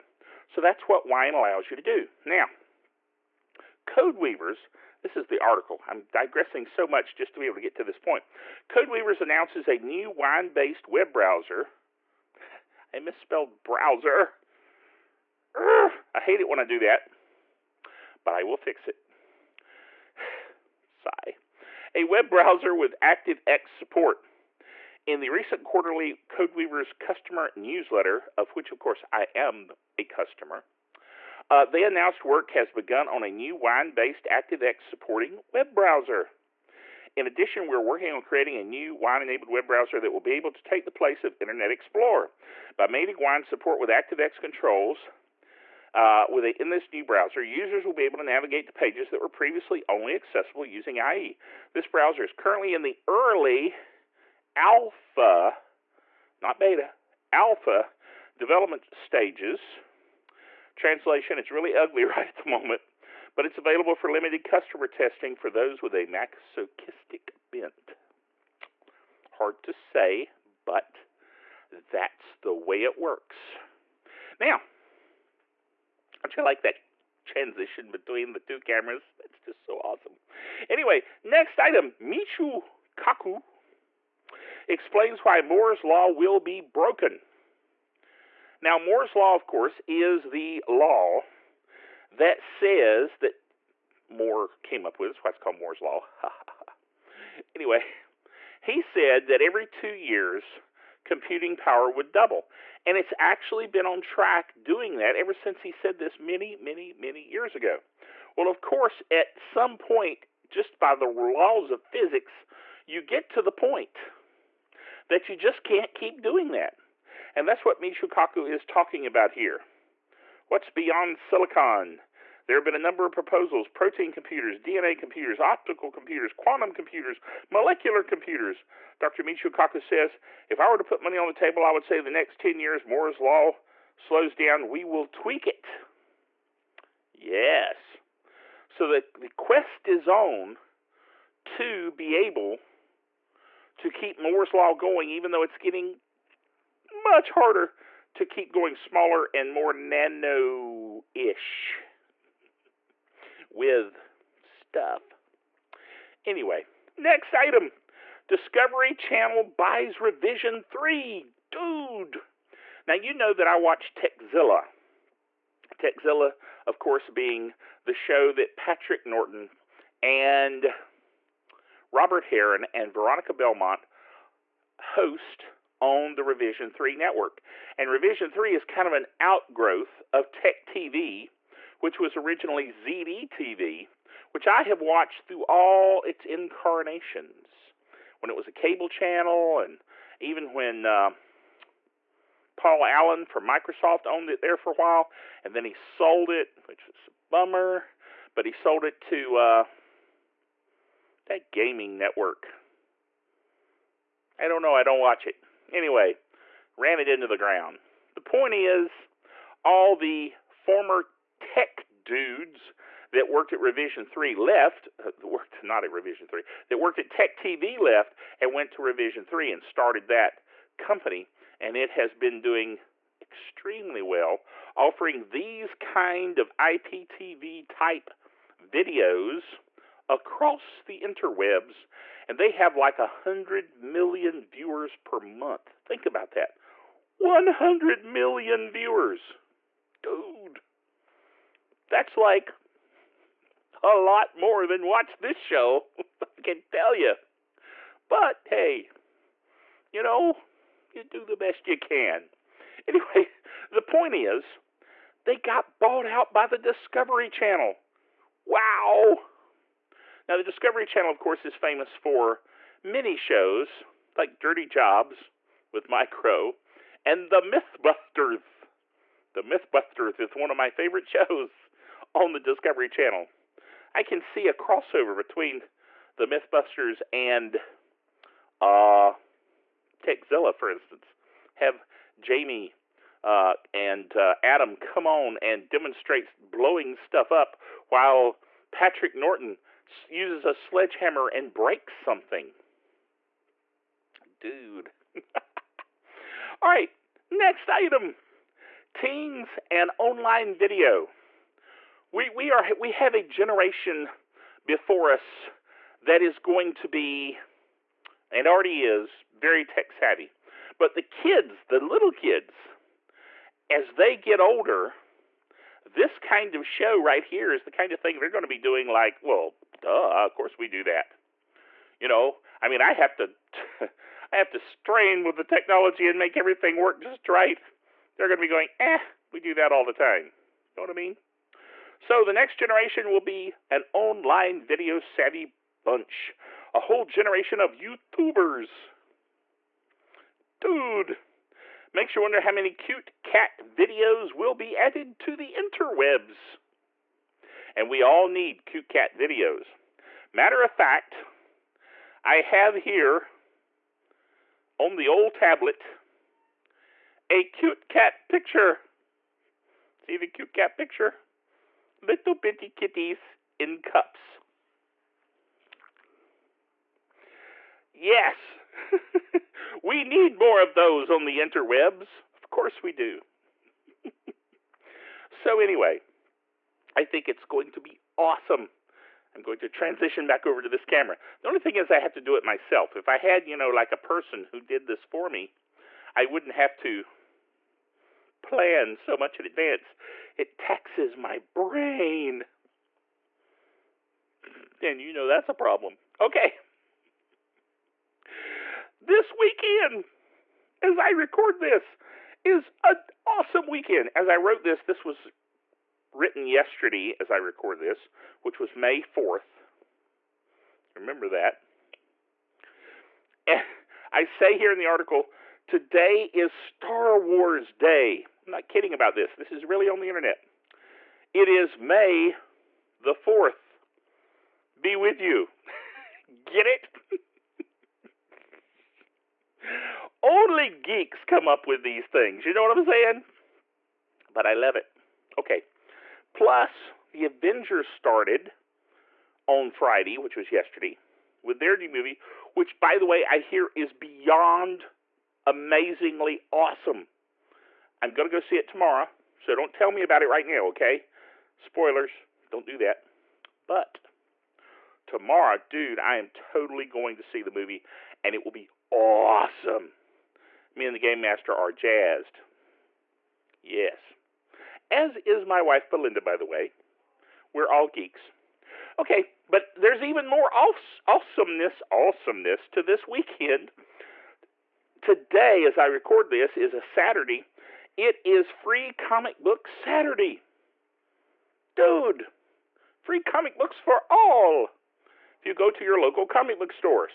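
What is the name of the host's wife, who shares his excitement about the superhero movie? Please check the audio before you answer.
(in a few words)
Belinda.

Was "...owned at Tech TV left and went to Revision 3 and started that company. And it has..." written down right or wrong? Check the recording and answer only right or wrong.
wrong.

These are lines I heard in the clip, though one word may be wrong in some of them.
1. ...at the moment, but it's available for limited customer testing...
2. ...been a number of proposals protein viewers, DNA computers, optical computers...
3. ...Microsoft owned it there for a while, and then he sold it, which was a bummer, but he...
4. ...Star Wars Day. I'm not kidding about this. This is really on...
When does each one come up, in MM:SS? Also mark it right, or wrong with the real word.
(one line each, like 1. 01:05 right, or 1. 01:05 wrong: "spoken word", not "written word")
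1. 01:02 right
2. 02:02 wrong: "computers", not "viewers"
3. 03:13 right
4. 06:56 right.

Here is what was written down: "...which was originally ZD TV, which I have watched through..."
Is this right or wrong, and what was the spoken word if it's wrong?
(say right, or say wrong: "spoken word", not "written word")
right.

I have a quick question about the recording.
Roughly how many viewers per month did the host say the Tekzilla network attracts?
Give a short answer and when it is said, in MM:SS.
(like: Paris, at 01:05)
100 million, at 03:52.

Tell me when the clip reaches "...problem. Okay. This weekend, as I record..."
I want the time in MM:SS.
06:35.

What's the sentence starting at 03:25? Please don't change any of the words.
Anyway, ran it into the ground.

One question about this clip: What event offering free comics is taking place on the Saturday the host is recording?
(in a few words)
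Free Comic Book Saturday.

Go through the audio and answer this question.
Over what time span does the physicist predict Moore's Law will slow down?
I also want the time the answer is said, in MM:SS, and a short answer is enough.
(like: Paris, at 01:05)
10 years, at 02:12.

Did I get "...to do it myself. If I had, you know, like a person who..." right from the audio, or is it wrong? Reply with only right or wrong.
right.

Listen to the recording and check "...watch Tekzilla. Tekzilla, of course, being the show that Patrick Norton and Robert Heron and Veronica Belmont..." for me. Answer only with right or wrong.
right.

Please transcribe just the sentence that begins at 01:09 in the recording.
Hard to say, but that's the way it works.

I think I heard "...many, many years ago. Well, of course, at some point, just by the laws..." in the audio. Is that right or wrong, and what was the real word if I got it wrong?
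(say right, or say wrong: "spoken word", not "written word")
right.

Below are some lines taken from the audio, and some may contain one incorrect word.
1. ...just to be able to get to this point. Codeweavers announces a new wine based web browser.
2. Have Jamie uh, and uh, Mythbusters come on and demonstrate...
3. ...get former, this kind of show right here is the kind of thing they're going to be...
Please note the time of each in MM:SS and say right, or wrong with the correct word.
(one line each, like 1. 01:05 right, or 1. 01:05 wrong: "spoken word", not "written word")
1. 00:07 right
2. 04:41 wrong: "Adam", not "Mythbusters"
3. 05:14 wrong: "older", not "former".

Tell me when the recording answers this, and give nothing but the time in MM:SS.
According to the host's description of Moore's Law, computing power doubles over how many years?
01:39.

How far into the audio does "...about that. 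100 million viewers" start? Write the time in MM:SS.
03:56.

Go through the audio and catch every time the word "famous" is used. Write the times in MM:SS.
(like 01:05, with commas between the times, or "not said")
04:21.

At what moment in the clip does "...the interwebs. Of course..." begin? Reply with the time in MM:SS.
06:11.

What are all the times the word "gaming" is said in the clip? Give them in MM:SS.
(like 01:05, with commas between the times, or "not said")
03:21.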